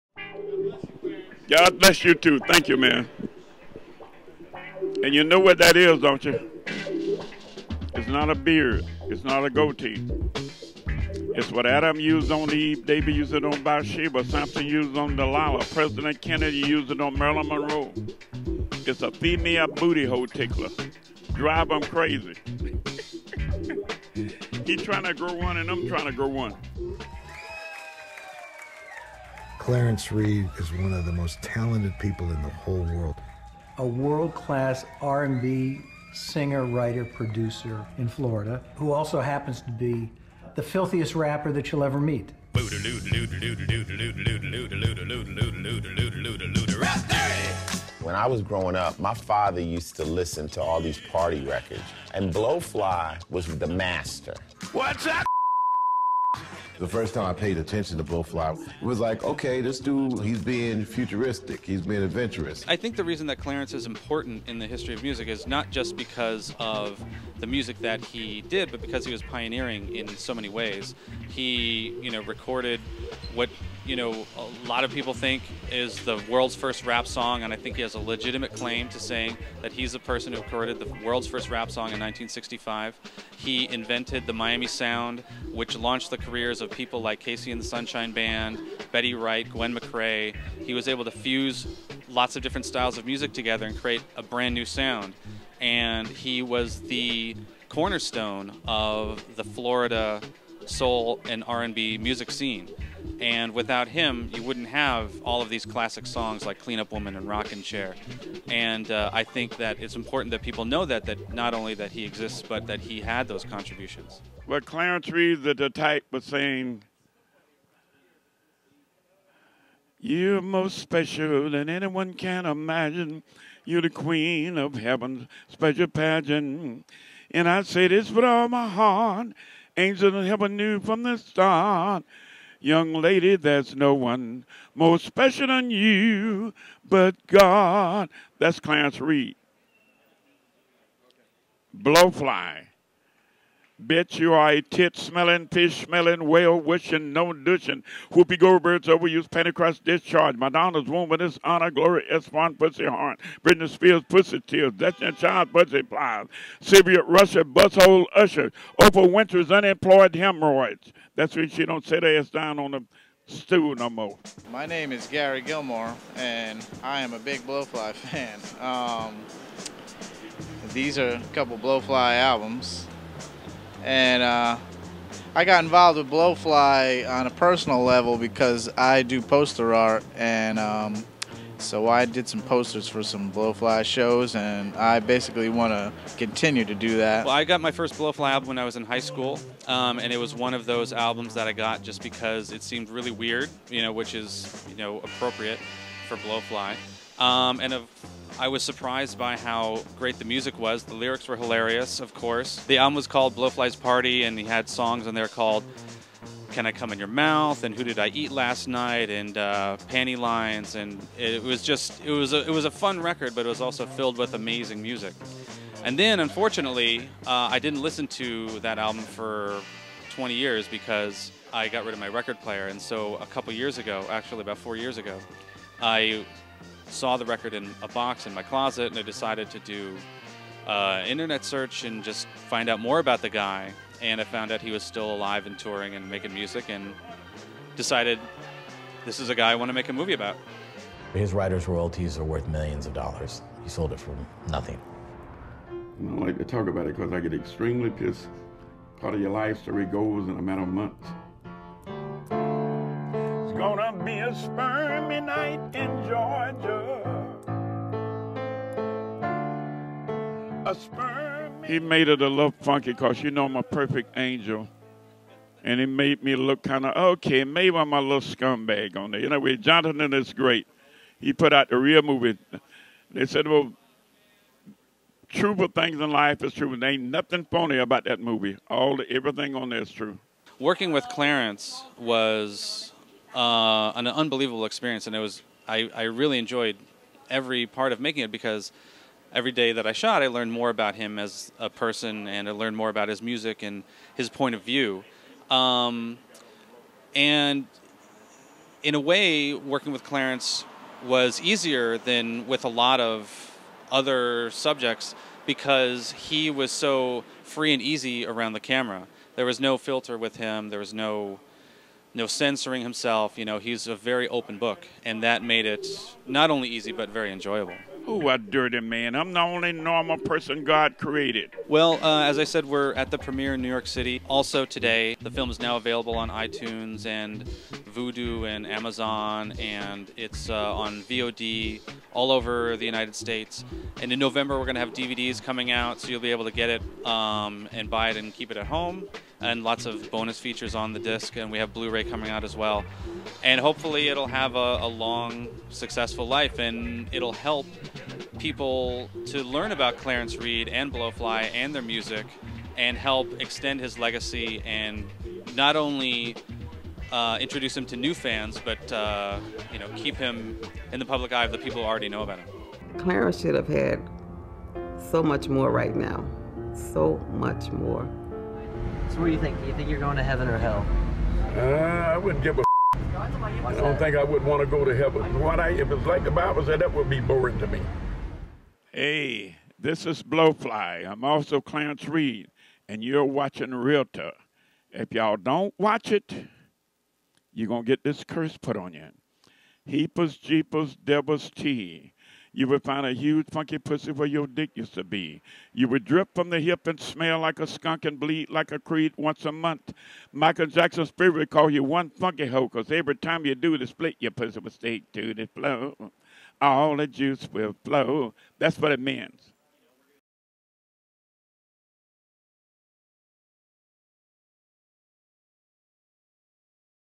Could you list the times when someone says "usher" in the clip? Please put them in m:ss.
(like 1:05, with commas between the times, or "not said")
2:38.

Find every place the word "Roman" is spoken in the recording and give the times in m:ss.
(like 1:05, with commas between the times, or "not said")
not said.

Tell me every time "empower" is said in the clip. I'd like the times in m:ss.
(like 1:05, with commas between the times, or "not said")
not said.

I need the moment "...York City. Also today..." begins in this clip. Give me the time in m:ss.
5:23.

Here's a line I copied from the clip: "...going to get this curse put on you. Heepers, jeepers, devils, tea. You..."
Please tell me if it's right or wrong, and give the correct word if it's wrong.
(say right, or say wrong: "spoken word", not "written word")
right.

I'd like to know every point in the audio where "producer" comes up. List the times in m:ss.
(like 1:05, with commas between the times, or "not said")
0:37.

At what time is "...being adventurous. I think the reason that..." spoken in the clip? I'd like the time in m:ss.
1:01.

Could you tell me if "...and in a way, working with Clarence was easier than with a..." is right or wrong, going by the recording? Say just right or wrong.
right.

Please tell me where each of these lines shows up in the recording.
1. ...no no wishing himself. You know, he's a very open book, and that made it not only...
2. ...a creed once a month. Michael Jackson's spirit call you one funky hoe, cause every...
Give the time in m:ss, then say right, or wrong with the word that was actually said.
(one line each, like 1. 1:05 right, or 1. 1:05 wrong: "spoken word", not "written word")
1. 5:10 wrong: "censoring", not "wishing"
2. 6:38 right.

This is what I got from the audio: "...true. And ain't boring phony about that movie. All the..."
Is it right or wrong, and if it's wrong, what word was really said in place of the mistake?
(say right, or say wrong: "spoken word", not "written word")
wrong: "nothing", not "boring".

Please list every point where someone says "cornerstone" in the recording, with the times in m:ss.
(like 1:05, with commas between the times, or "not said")
1:37.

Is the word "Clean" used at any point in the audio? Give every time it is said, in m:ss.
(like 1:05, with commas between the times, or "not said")
1:46.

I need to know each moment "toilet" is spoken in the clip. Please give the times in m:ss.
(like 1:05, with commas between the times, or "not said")
not said.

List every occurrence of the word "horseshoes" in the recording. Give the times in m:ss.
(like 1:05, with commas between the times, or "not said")
not said.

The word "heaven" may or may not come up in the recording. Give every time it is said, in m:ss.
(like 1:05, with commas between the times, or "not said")
2:04, 2:10, 6:10, 6:14.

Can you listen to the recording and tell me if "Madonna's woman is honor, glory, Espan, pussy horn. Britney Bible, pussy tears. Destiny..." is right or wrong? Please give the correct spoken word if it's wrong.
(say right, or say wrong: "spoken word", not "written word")
wrong: "Spears", not "Bible".